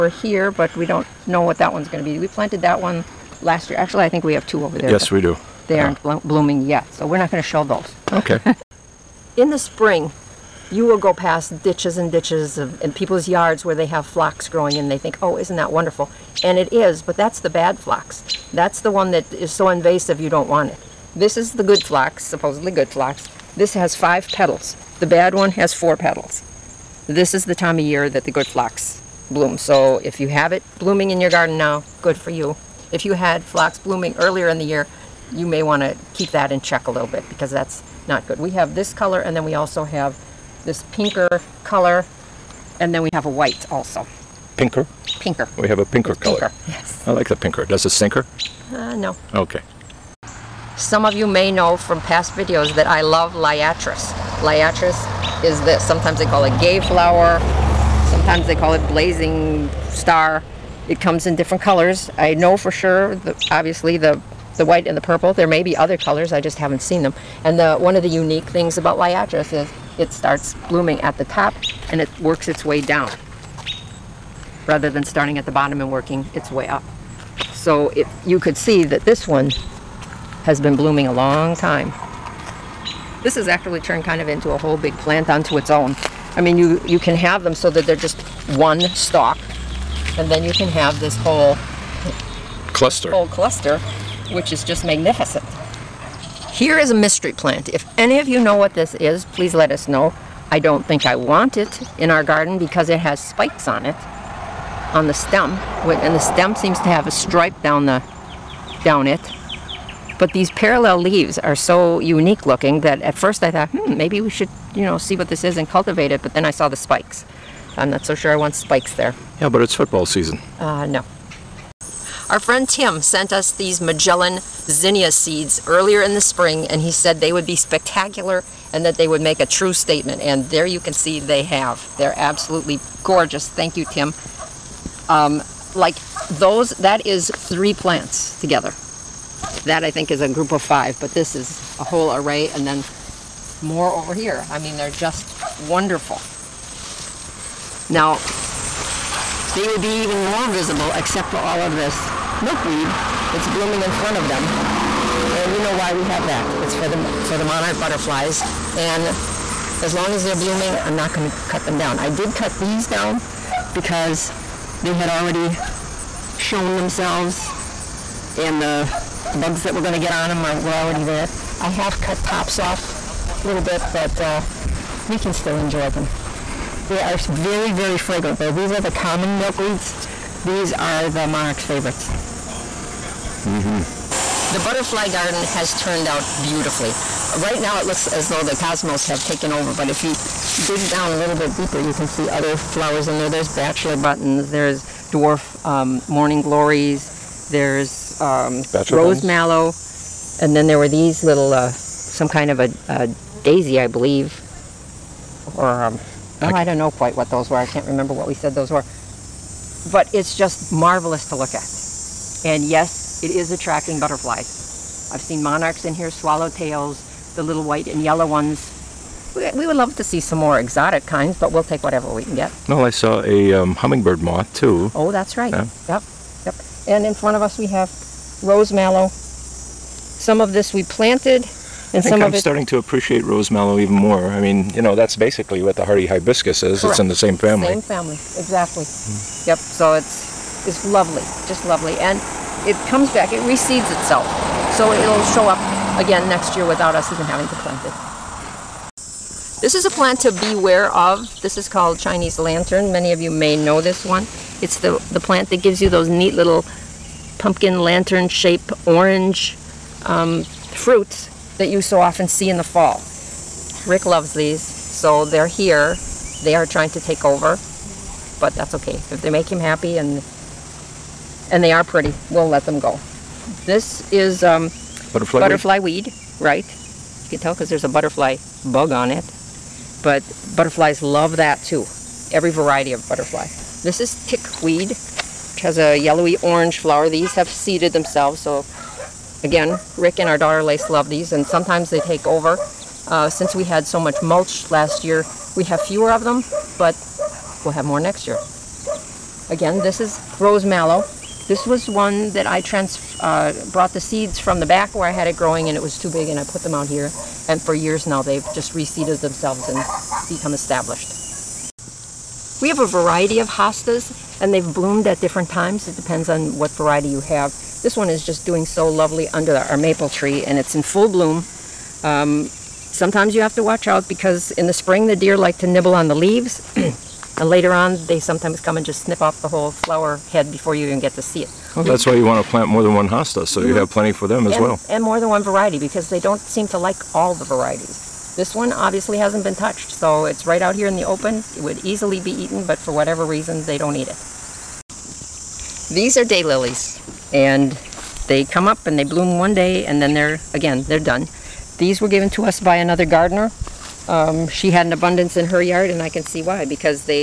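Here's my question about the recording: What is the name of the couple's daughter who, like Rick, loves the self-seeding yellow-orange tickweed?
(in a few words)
Lace.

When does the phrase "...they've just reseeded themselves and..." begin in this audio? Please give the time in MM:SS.
05:08.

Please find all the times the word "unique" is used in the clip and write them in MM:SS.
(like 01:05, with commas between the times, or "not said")
01:08, 01:51.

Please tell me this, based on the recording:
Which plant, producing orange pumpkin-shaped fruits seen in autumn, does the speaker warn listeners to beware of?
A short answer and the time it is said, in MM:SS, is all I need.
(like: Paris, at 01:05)
Chinese lantern, at 04:11.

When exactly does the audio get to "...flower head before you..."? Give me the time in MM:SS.
05:29.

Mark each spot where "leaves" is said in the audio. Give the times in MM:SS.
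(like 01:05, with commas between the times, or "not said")
01:50, 05:26.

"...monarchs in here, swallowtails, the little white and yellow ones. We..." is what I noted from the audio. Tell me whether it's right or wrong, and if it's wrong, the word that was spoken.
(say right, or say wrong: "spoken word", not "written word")
right.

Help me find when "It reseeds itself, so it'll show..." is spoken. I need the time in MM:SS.
04:03.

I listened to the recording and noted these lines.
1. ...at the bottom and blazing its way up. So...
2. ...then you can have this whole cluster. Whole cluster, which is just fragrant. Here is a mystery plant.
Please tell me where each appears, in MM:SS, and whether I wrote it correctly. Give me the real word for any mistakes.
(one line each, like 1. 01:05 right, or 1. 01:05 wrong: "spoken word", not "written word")
1. 01:15 wrong: "working", not "blazing"
2. 01:30 wrong: "magnificent", not "fragrant".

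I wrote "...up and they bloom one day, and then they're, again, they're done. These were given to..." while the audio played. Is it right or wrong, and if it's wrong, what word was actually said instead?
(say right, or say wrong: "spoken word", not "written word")
right.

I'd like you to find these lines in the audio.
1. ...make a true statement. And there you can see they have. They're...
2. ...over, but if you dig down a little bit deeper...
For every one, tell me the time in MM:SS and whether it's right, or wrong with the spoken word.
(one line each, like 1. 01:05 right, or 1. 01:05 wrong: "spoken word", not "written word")
1. 02:09 right
2. 03:09 right.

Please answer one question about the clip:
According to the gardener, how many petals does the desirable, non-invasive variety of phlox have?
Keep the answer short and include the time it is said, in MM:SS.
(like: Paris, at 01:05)
5, at 00:23.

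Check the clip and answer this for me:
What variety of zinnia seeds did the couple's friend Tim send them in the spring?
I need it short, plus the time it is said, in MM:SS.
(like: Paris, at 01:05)
Magellan, at 02:03.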